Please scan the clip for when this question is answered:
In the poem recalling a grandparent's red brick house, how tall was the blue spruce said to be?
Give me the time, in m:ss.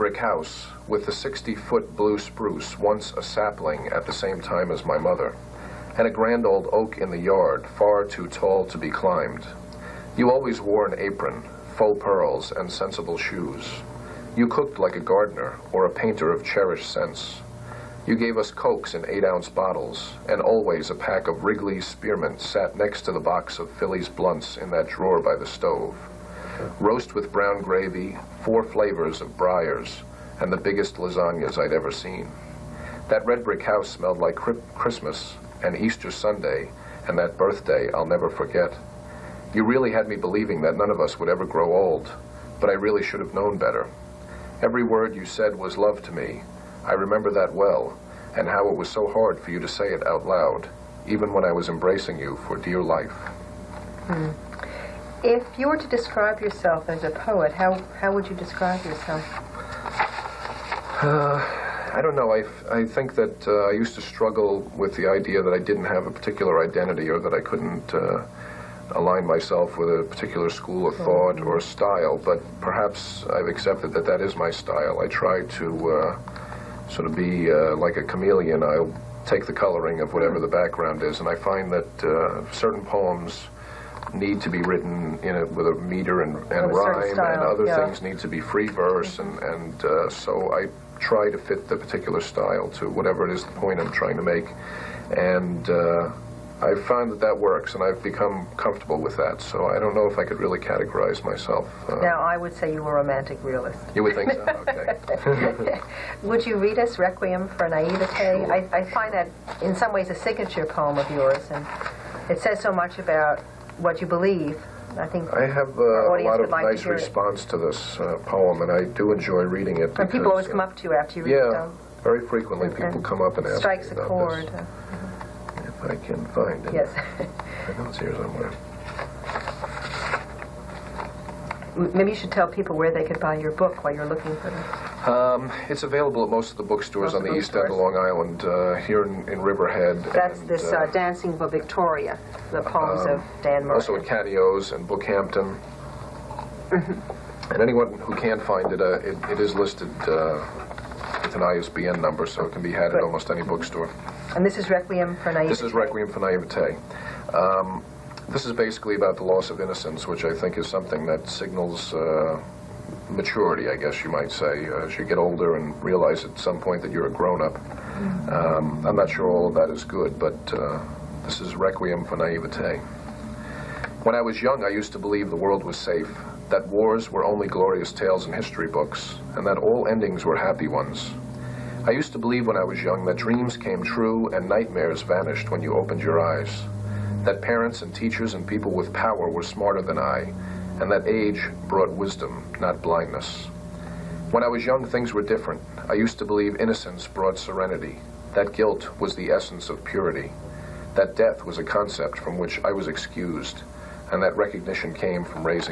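0:01.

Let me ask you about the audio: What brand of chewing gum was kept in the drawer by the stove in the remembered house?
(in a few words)
Wrigley's Spearmint.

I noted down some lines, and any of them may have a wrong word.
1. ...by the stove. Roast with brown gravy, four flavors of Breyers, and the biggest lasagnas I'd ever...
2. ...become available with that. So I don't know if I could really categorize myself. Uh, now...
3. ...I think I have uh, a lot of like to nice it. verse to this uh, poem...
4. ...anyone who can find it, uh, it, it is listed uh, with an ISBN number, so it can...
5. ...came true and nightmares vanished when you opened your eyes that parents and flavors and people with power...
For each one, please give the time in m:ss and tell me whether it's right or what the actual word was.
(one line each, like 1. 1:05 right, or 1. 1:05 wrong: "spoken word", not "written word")
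1. 0:25 right
2. 1:38 wrong: "comfortable", not "available"
3. 1:54 wrong: "response", not "verse"
4. 2:27 right
5. 3:03 wrong: "teachers", not "flavors".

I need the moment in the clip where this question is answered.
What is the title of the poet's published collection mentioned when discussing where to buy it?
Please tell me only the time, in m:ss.
2:20.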